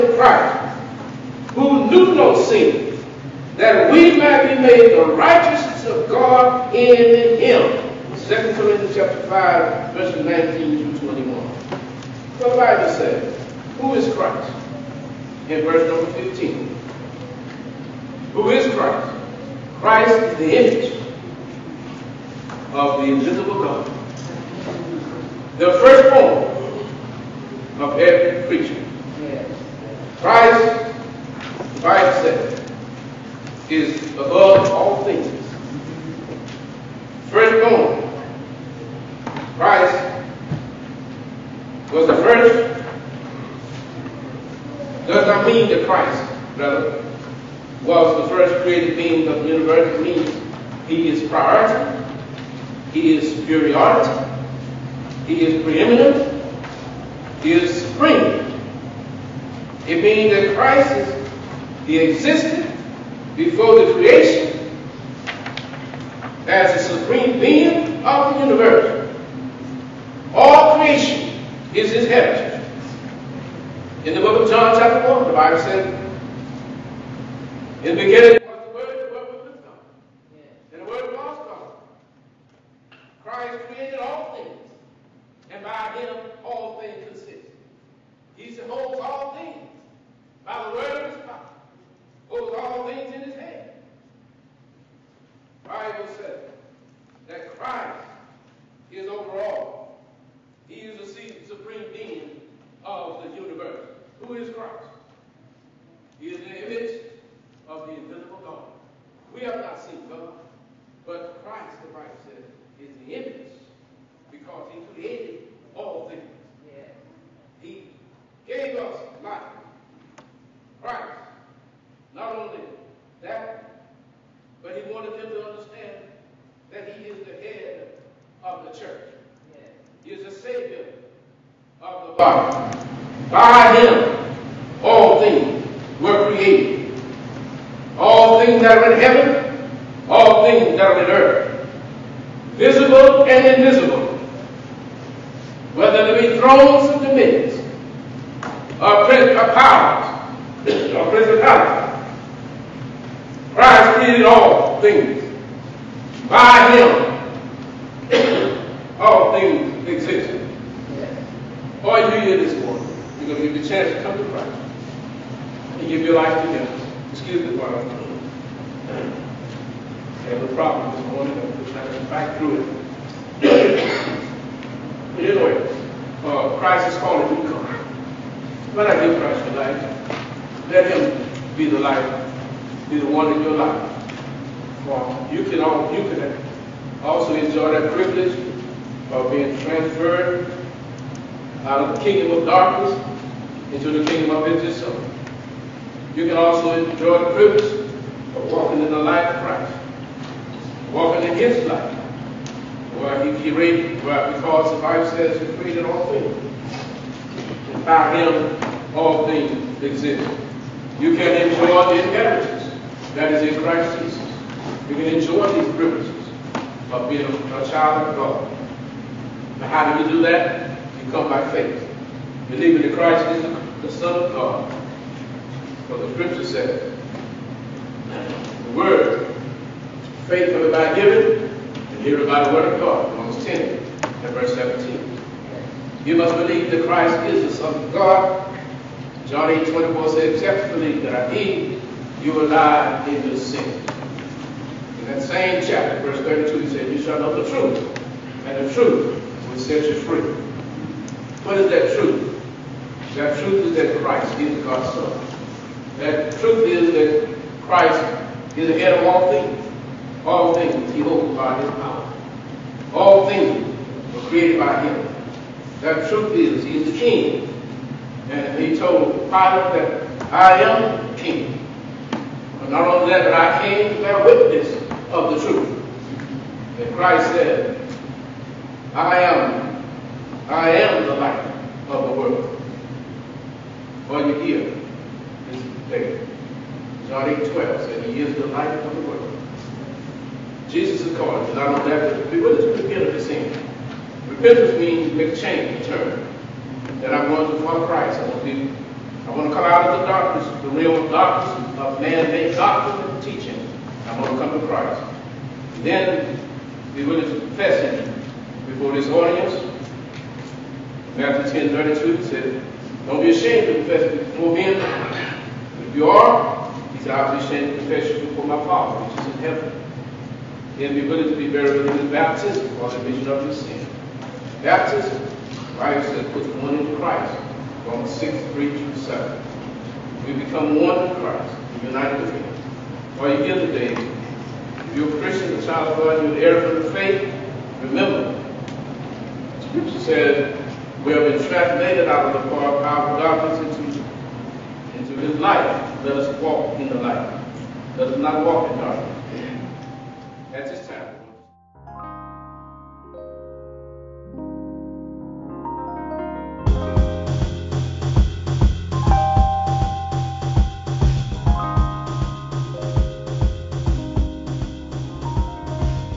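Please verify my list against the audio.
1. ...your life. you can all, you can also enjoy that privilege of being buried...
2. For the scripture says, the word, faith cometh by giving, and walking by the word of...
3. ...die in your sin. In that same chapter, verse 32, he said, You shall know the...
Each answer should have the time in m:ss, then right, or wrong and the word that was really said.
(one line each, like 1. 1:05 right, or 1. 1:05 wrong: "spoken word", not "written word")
1. 3:03 wrong: "transferred", not "buried"
2. 3:45 wrong: "hearing", not "walking"
3. 4:02 right.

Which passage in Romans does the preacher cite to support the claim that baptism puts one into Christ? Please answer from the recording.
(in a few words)
Romans 6:3-7.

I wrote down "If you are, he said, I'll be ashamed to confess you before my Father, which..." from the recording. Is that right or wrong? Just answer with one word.
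right.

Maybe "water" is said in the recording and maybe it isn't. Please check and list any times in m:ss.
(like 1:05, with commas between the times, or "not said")
not said.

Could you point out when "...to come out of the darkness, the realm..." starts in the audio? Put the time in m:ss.
4:59.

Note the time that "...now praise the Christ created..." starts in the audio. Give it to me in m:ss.
2:30.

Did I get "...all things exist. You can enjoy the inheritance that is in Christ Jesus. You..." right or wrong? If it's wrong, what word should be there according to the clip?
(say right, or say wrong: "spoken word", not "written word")
right.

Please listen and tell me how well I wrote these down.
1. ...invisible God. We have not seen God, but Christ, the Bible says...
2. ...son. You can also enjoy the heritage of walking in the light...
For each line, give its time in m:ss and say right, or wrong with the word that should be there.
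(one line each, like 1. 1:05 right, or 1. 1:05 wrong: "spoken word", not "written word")
1. 1:47 right
2. 3:14 wrong: "privilege", not "heritage".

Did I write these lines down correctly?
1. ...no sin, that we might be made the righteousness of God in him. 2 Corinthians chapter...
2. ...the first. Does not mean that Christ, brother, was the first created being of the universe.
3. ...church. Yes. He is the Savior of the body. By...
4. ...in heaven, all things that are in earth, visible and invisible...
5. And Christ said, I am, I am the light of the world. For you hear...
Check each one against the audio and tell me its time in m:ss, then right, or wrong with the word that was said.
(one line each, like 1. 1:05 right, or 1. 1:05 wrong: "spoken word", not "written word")
1. 0:02 right
2. 0:42 right
3. 2:08 right
4. 2:18 right
5. 4:36 right.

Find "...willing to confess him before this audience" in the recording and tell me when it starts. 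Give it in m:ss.
5:07.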